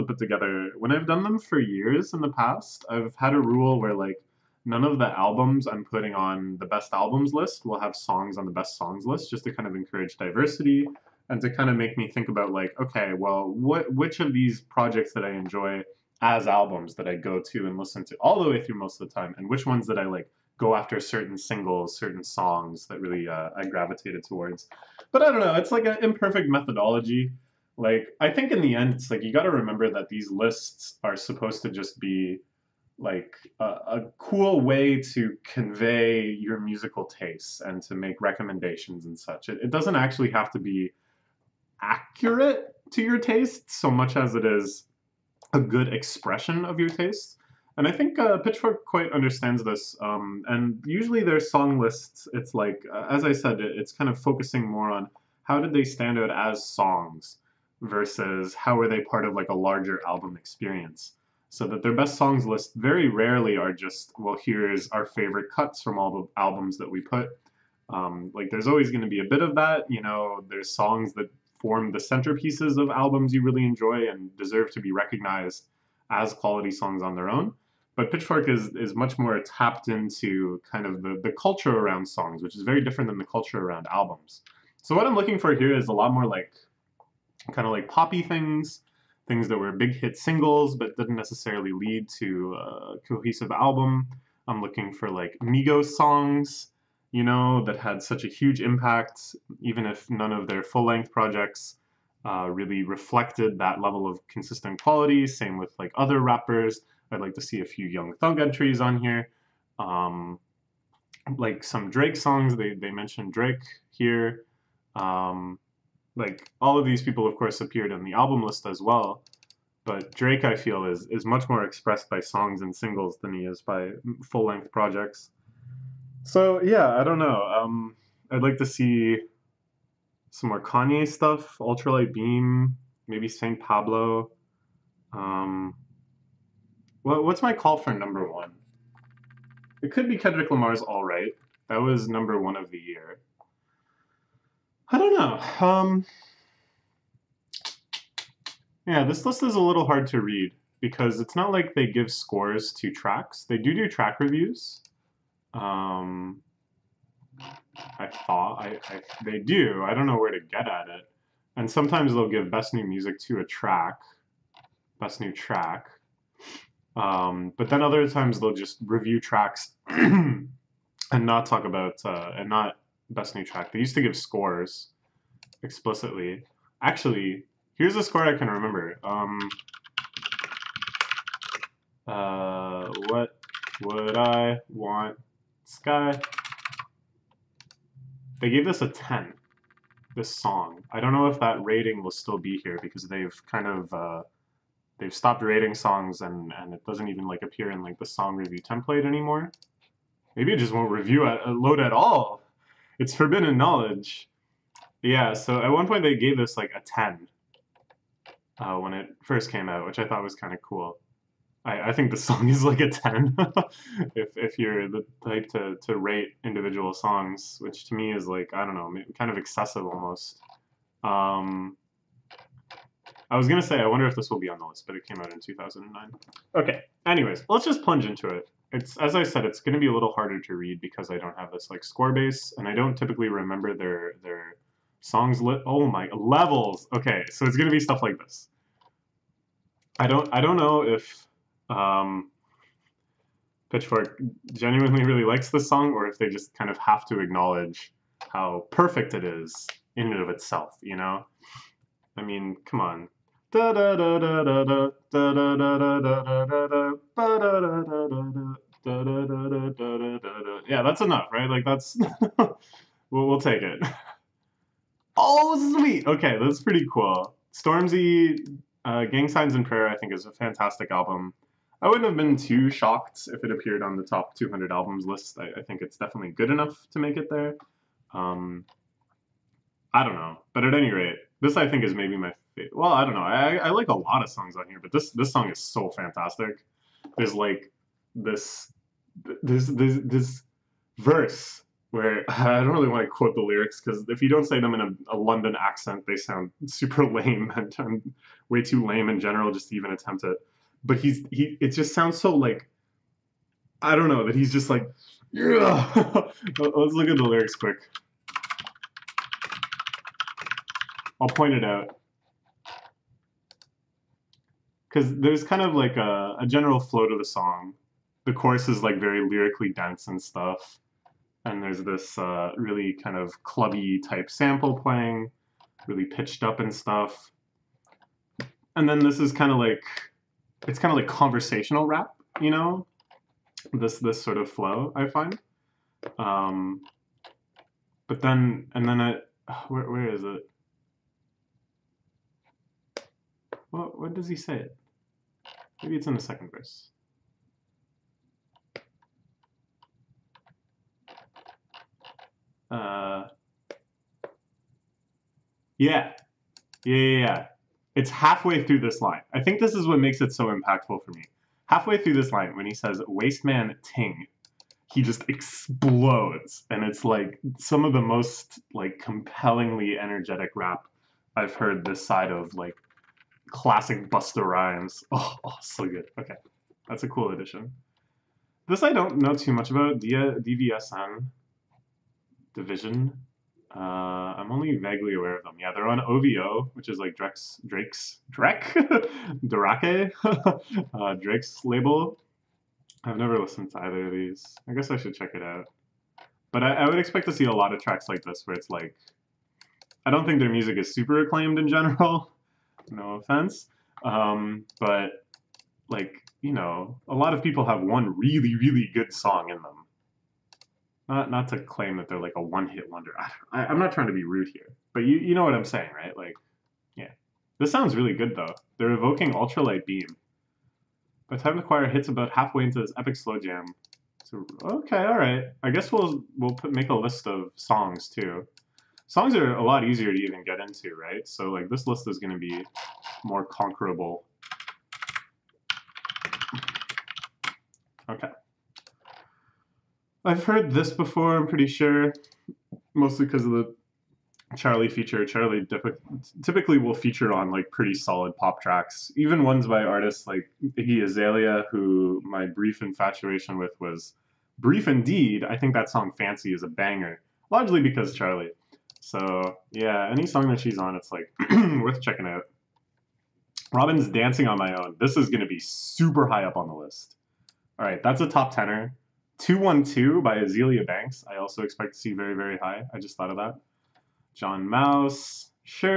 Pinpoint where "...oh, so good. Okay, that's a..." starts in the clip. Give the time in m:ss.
6:15.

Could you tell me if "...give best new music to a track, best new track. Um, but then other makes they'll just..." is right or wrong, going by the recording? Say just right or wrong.
wrong.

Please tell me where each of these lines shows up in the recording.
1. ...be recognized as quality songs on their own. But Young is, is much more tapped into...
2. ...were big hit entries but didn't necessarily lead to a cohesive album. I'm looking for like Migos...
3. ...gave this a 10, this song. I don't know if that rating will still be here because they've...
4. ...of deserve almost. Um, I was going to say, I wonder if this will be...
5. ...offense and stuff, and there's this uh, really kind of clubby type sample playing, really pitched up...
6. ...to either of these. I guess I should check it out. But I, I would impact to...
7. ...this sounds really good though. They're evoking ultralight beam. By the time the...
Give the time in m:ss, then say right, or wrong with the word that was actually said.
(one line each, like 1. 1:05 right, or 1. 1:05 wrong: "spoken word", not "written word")
1. 1:14 wrong: "Pitchfork", not "Young"
2. 1:29 wrong: "singles", not "entries"
3. 3:08 right
4. 3:39 wrong: "excessive", not "deserve"
5. 5:19 wrong: "dense", not "offense"
6. 6:33 wrong: "expect", not "impact"
7. 6:57 right.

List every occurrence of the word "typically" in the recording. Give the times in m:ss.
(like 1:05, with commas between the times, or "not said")
3:52, 7:26.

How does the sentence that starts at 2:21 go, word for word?
That was number one of the year.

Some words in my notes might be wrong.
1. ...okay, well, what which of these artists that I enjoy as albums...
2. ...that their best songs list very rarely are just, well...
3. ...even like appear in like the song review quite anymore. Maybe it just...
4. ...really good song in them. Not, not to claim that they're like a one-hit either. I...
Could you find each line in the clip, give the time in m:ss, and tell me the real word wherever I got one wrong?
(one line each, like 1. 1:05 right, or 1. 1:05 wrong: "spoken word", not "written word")
1. 0:12 wrong: "projects", not "artists"
2. 1:01 right
3. 3:17 wrong: "template", not "quite"
4. 6:48 wrong: "wonder", not "either".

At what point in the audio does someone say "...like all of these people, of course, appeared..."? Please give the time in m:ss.
1:56.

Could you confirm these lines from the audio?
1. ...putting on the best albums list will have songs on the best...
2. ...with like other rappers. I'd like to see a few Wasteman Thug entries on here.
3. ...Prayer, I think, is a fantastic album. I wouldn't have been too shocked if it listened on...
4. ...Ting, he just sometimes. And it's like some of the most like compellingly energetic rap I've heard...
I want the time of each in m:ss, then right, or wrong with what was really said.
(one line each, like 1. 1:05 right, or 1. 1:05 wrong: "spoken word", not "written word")
1. 0:05 right
2. 1:45 wrong: "Young", not "Wasteman"
3. 4:29 wrong: "appeared", not "listened"
4. 6:03 wrong: "explodes", not "sometimes".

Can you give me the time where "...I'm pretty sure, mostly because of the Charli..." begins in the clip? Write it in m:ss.
7:21.